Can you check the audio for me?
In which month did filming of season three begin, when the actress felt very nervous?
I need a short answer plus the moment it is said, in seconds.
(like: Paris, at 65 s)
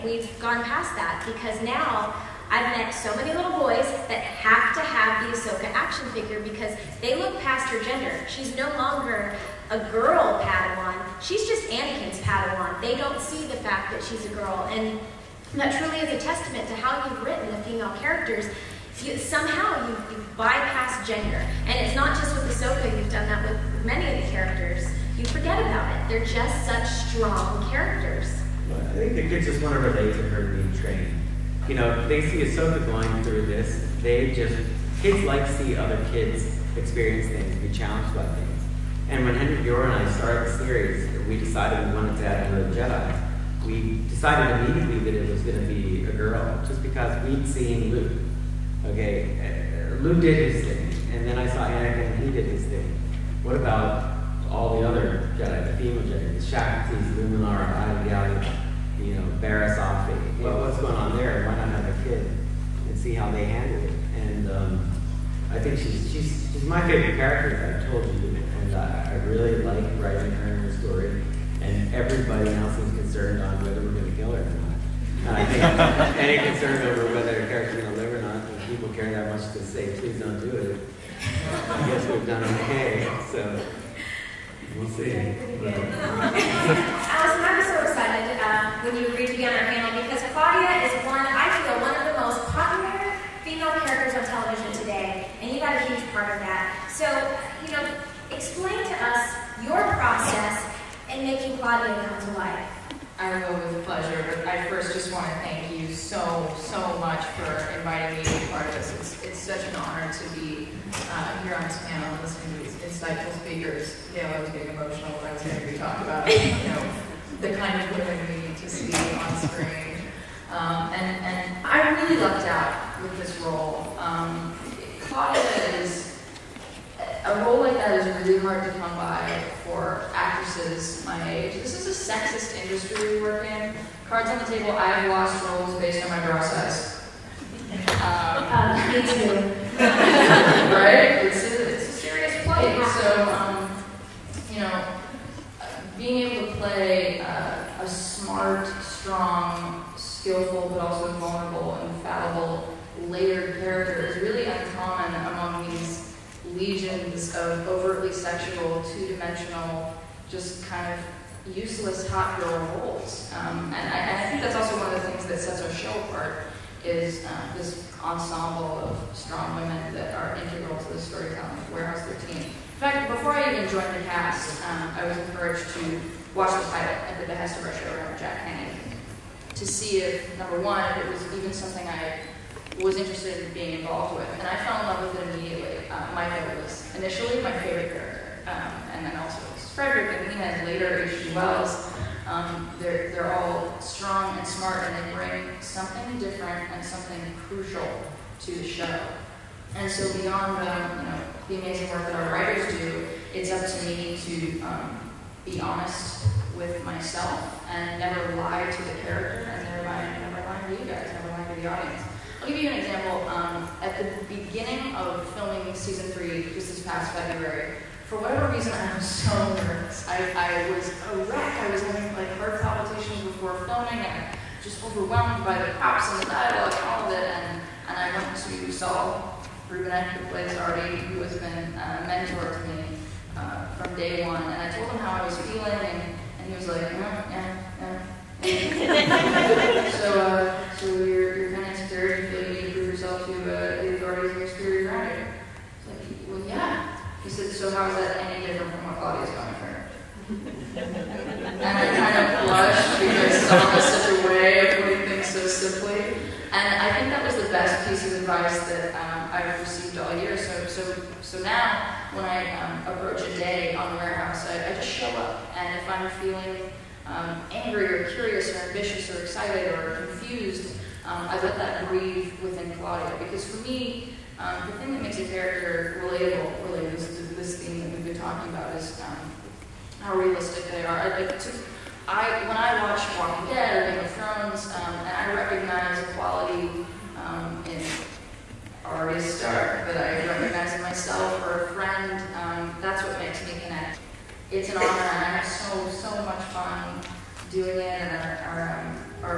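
February, at 217 s.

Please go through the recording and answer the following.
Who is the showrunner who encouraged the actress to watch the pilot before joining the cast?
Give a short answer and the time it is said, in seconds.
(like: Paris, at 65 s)
Jack Kenny, at 178 s.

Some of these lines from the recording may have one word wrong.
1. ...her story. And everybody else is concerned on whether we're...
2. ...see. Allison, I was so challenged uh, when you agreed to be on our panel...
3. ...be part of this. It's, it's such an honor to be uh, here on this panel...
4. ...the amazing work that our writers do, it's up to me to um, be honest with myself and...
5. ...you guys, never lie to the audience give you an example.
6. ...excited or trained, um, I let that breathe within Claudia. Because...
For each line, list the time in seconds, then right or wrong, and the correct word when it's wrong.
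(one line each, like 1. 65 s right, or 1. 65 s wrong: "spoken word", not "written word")
1. 70 s right
2. 84 s wrong: "excited", not "challenged"
3. 108 s right
4. 201 s right
5. 210 s right
6. 269 s wrong: "confused", not "trained".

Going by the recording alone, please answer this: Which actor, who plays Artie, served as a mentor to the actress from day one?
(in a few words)
Saul Rubinek.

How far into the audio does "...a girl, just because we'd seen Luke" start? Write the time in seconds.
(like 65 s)
46 s.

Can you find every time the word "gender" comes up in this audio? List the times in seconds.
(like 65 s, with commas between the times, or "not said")
7 s, 21 s.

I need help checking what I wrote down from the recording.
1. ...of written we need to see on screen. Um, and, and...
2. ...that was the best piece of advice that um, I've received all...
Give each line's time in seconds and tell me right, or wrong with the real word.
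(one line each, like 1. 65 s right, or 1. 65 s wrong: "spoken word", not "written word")
1. 117 s wrong: "women", not "written"
2. 257 s right.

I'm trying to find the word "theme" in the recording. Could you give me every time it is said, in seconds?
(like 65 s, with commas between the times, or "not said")
277 s.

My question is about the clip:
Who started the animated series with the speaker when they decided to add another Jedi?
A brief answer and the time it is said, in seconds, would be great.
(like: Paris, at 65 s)
Henry Gilroy, at 39 s.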